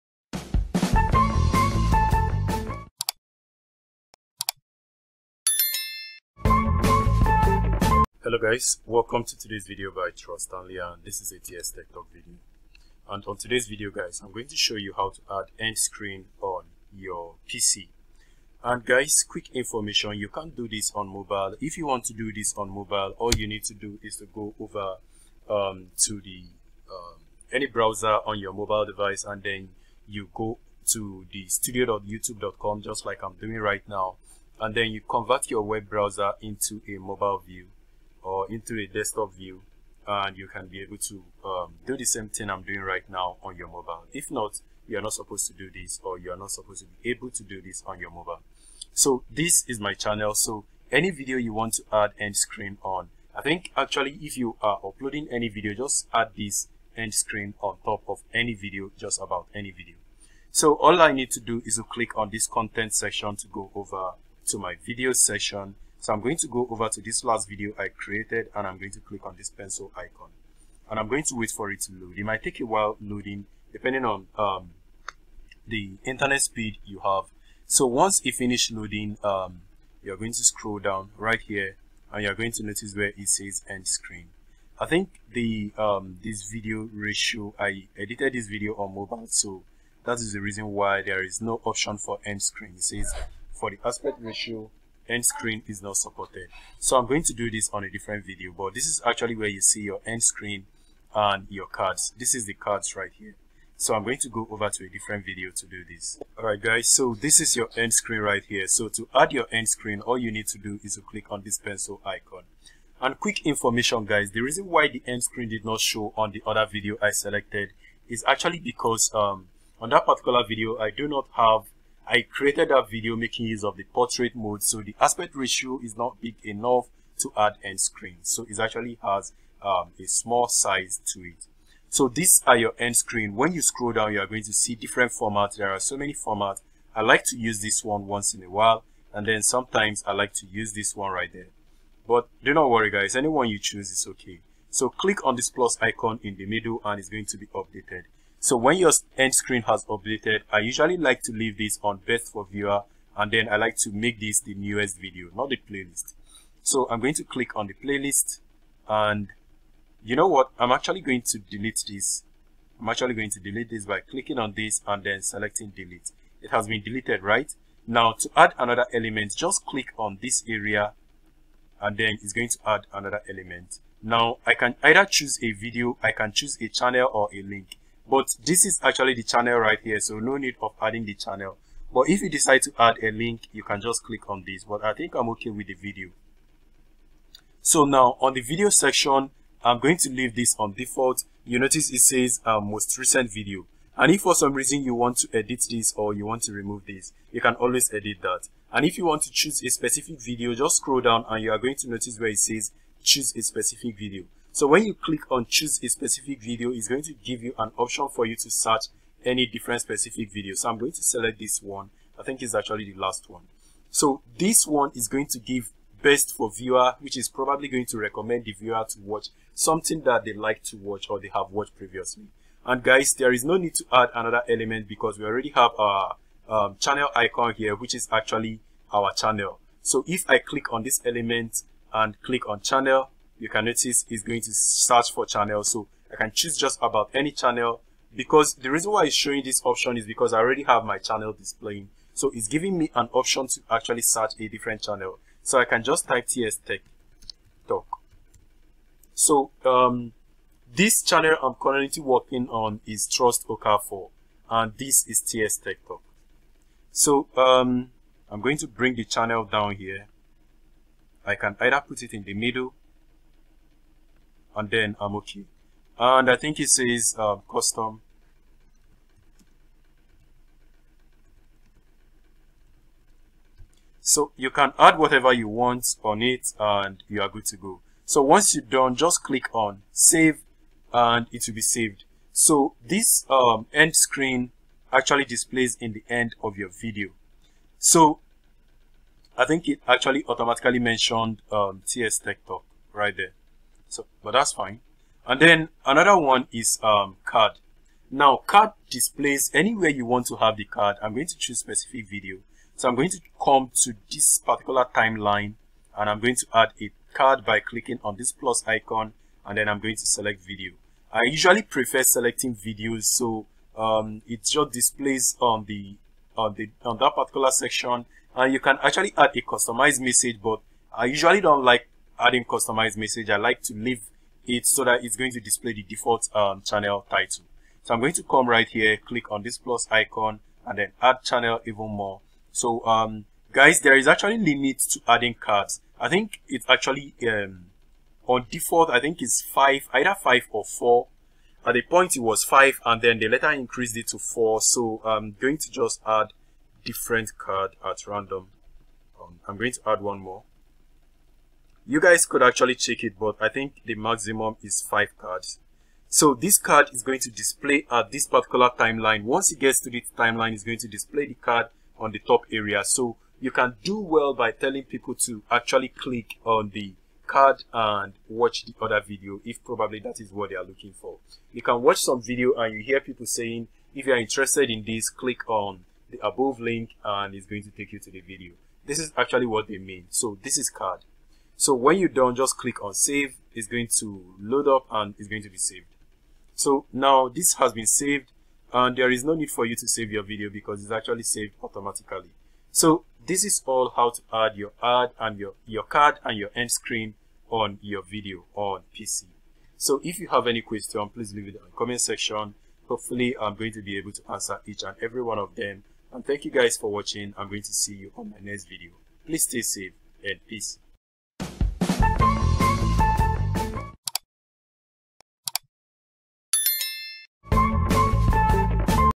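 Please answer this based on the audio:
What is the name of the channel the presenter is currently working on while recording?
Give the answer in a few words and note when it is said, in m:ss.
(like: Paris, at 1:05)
Trust OK4, at 4:13.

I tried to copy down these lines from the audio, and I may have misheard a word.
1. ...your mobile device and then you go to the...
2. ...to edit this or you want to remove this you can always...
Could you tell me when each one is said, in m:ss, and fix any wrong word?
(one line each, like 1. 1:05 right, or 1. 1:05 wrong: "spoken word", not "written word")
1. 0:28 right
2. 3:15 right.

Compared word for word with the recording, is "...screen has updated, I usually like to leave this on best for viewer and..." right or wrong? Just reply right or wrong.
right.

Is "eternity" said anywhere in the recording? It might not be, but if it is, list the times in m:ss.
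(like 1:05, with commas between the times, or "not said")
not said.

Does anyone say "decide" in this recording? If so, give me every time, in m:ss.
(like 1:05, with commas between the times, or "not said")
3:02.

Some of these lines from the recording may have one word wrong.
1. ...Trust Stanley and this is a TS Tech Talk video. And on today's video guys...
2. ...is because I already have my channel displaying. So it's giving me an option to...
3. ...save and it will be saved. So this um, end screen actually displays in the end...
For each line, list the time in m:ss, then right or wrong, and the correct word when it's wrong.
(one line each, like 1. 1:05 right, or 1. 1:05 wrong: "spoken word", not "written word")
1. 0:10 right
2. 3:59 right
3. 4:39 right.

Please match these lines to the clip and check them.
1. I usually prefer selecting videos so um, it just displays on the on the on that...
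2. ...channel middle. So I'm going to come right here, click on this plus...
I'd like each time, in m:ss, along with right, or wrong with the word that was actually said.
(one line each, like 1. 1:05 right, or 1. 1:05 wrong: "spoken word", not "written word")
1. 5:11 right
2. 5:26 wrong: "title", not "middle".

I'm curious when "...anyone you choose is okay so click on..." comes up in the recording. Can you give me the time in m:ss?
2:23.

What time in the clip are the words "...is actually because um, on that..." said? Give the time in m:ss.
1:58.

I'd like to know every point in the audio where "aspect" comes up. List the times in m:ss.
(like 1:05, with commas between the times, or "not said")
1:33, 2:04.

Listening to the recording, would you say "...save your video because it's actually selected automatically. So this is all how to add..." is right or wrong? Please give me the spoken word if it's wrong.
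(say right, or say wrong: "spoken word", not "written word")
wrong: "saved", not "selected".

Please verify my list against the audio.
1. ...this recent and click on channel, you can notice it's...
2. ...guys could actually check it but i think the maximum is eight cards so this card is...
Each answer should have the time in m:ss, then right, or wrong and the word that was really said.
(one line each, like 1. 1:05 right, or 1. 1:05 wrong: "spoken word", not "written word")
1. 3:50 wrong: "element", not "recent"
2. 5:51 wrong: "five", not "eight".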